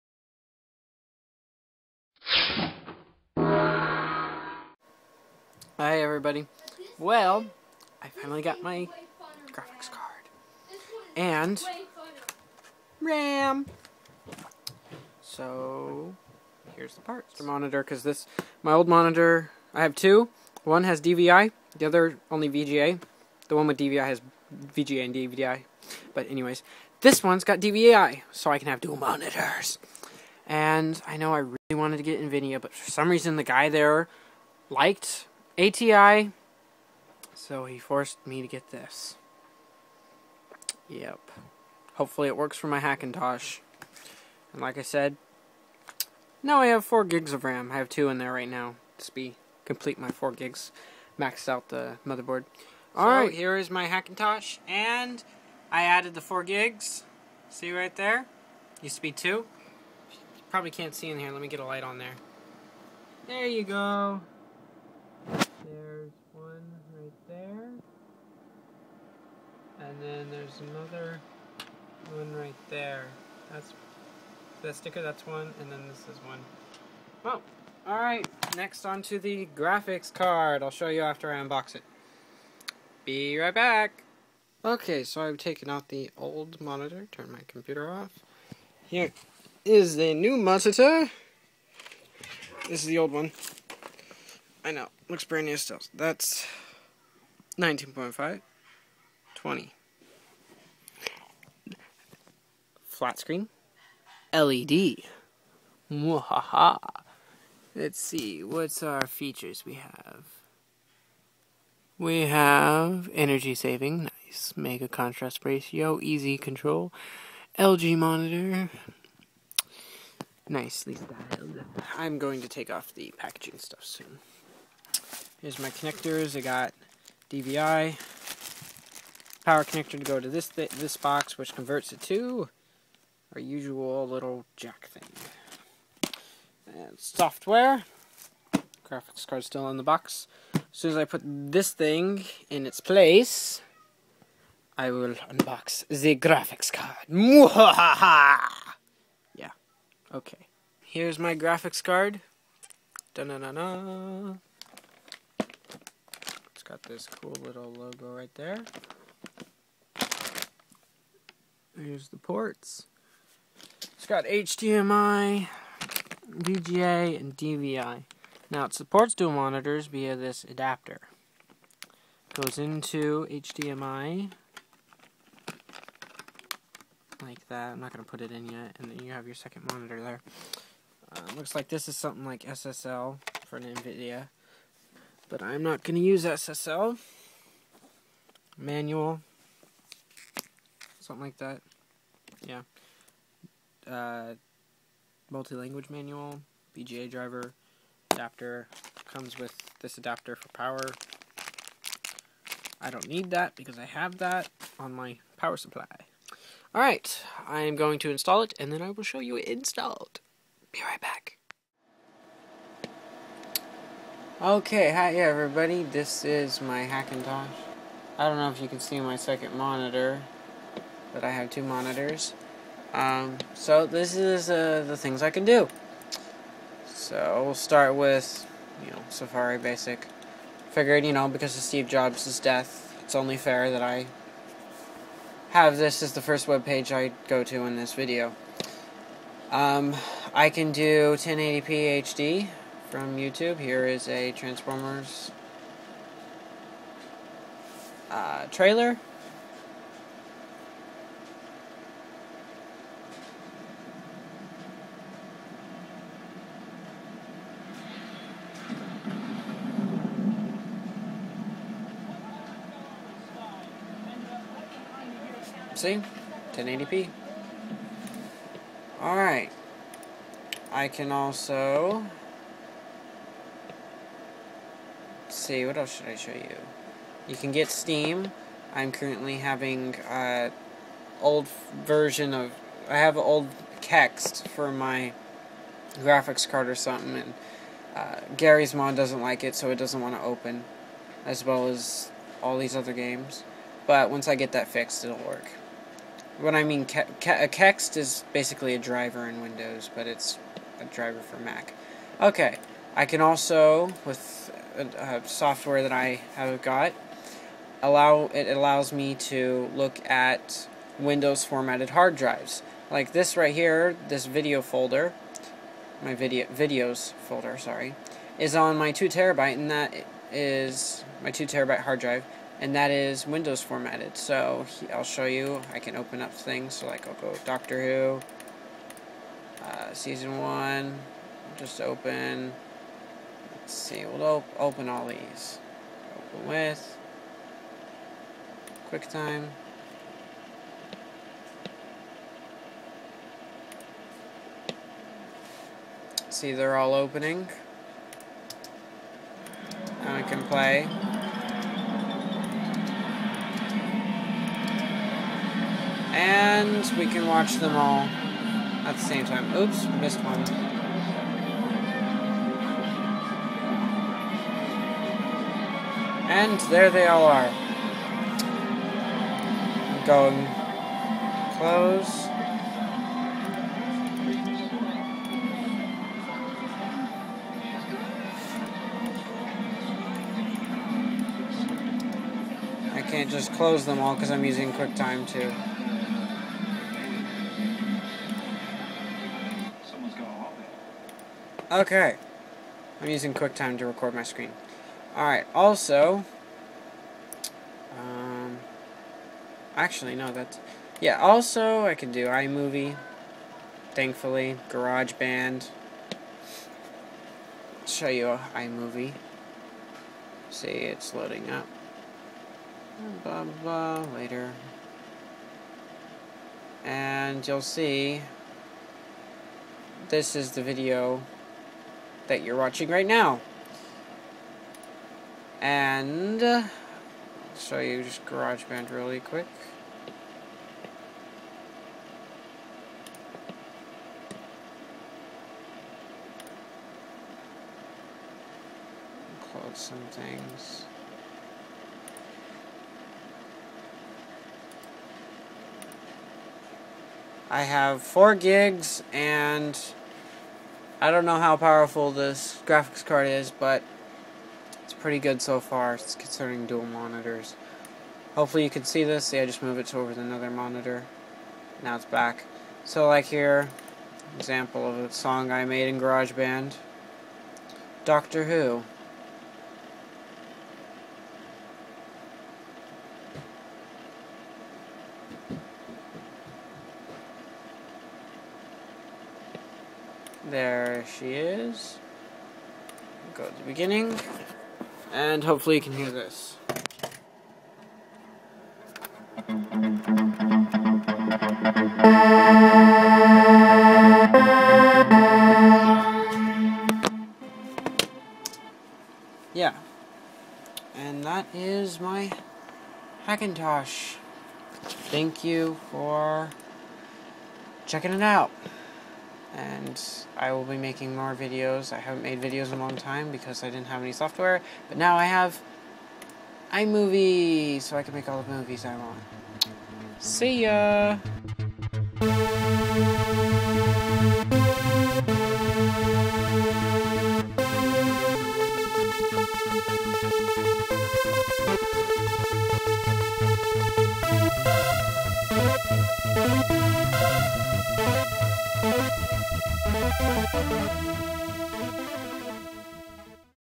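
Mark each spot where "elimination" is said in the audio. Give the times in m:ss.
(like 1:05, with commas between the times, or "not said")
not said.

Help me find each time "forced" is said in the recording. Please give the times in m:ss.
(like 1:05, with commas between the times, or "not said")
0:37.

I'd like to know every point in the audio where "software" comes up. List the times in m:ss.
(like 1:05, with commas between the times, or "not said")
2:16, 5:05, 8:34.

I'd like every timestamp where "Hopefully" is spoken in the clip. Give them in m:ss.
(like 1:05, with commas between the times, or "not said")
0:41, 7:38.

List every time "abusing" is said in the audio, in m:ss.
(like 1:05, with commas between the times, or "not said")
not said.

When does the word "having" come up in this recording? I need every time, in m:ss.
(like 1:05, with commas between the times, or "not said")
4:39.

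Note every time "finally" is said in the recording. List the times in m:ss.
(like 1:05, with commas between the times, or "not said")
0:08.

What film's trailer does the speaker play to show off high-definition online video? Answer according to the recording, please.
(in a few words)
Transformers.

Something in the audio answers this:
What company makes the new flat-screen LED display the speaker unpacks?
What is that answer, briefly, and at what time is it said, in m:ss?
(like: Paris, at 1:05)
LG, at 1:57.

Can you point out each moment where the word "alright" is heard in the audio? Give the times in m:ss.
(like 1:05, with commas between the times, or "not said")
0:52, 1:17, 3:26, 4:29, 6:35.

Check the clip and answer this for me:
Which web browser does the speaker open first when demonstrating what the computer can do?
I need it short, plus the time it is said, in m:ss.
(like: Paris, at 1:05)
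Safari, at 3:49.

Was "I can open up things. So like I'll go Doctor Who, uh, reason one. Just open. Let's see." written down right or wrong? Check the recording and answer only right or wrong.
wrong.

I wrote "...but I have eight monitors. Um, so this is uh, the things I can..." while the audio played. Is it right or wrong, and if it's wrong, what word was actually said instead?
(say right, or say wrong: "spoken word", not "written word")
wrong: "two", not "eight".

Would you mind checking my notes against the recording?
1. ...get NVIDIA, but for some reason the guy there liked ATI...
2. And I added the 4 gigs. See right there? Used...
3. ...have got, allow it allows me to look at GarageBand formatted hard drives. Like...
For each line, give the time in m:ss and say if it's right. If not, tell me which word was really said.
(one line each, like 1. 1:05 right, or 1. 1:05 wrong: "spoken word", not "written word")
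1. 0:32 right
2. 0:54 right
3. 5:06 wrong: "Windows", not "GarageBand".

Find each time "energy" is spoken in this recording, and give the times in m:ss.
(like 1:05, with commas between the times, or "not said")
1:53.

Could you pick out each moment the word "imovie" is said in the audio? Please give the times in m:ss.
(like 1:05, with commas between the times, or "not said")
6:42, 6:48, 8:36.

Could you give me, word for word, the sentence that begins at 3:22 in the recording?
I don't need that because I have that on my power supply.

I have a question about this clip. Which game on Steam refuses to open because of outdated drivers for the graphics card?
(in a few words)
Garry's Mod.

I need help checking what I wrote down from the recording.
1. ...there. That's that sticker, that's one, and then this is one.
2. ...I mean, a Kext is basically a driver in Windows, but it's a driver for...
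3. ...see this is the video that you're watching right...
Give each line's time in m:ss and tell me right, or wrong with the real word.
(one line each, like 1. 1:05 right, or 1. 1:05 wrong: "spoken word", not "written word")
1. 1:12 right
2. 4:56 right
3. 6:57 right.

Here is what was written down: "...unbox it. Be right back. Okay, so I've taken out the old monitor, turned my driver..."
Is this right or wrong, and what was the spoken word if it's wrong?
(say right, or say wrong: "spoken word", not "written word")
wrong: "computer", not "driver".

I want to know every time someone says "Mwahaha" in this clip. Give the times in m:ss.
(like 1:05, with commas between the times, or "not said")
1:45.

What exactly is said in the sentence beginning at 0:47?
I have 2 in there right now.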